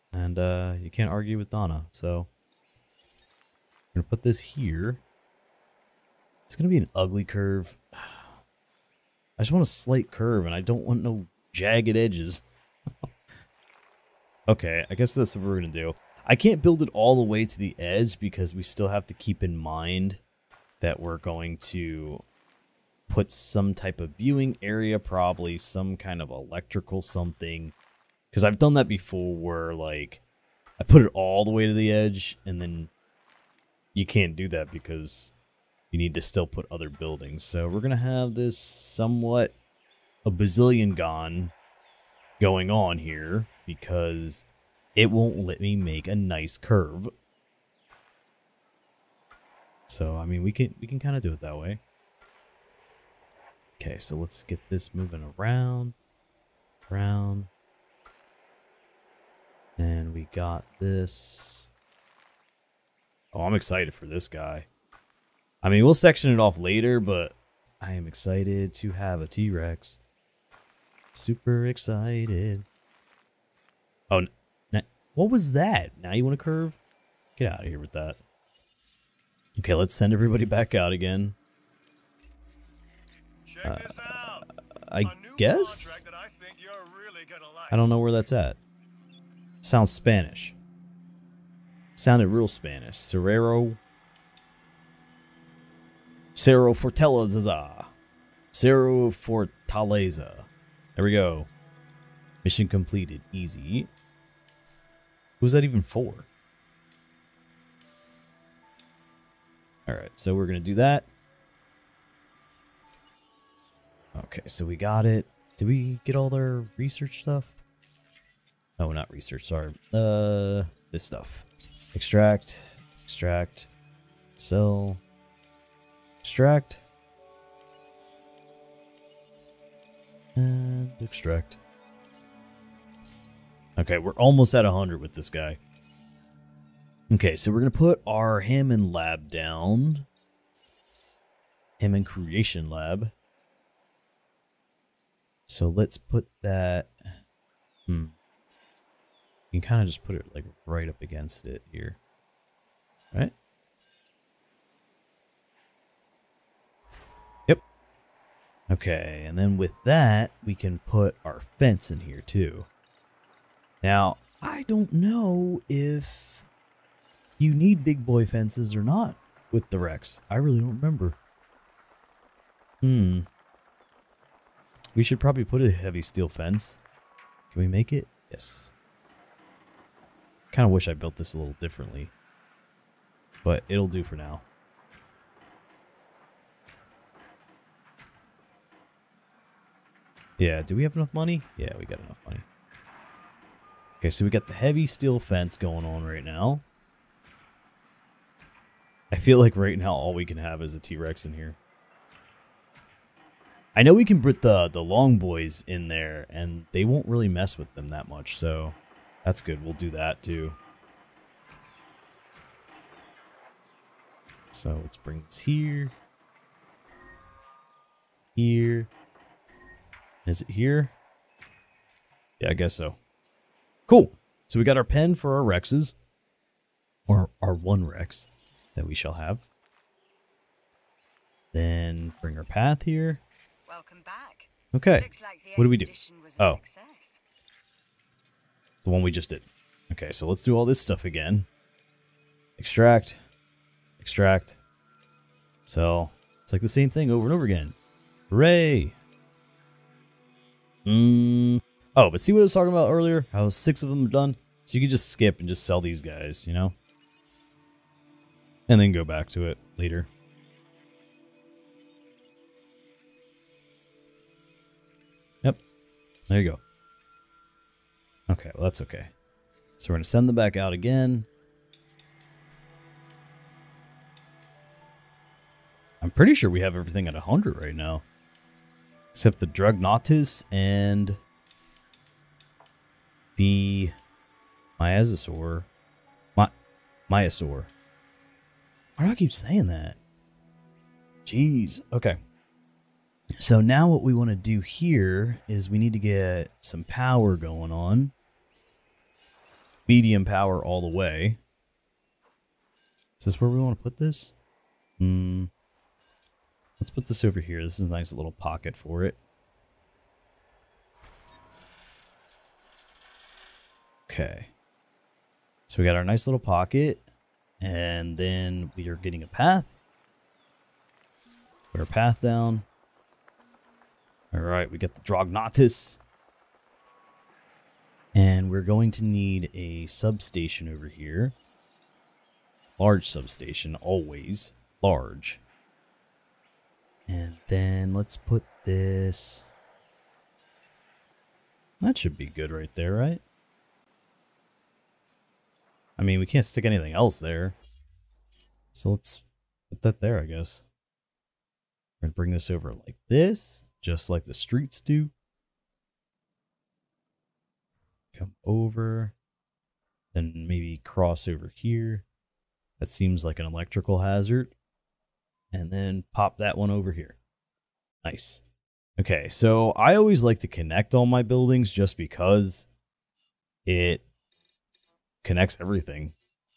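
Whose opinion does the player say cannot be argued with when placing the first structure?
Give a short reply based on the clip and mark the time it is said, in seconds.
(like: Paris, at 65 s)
Donna, at 1 s.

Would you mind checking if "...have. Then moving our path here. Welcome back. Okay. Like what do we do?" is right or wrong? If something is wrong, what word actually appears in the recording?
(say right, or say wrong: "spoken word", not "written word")
wrong: "bring", not "moving".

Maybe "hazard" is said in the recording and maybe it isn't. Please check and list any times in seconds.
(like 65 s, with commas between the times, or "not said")
364 s.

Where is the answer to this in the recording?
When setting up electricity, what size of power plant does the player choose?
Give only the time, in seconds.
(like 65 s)
299 s.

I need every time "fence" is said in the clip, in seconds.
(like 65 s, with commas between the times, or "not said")
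161 s, 168 s, 176 s, 195 s.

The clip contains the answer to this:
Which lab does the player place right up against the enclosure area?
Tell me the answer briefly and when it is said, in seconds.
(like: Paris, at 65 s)
Hammond Creation Lab, at 141 s.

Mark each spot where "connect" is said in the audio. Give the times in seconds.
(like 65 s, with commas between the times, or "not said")
370 s, 375 s.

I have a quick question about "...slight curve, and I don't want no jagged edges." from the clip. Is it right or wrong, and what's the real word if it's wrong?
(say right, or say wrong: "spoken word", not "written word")
right.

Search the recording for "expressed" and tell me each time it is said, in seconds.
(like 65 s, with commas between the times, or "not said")
not said.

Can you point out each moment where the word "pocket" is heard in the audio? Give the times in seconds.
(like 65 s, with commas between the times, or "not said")
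308 s, 316 s.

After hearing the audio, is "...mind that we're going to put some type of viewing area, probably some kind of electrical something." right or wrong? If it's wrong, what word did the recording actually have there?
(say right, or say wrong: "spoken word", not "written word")
right.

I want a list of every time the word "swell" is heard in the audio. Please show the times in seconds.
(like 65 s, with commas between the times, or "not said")
not said.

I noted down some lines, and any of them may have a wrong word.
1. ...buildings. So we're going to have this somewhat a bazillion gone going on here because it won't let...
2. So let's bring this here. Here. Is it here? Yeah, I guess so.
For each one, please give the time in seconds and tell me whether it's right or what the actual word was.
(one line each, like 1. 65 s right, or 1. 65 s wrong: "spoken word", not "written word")
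1. 36 s right
2. 214 s right.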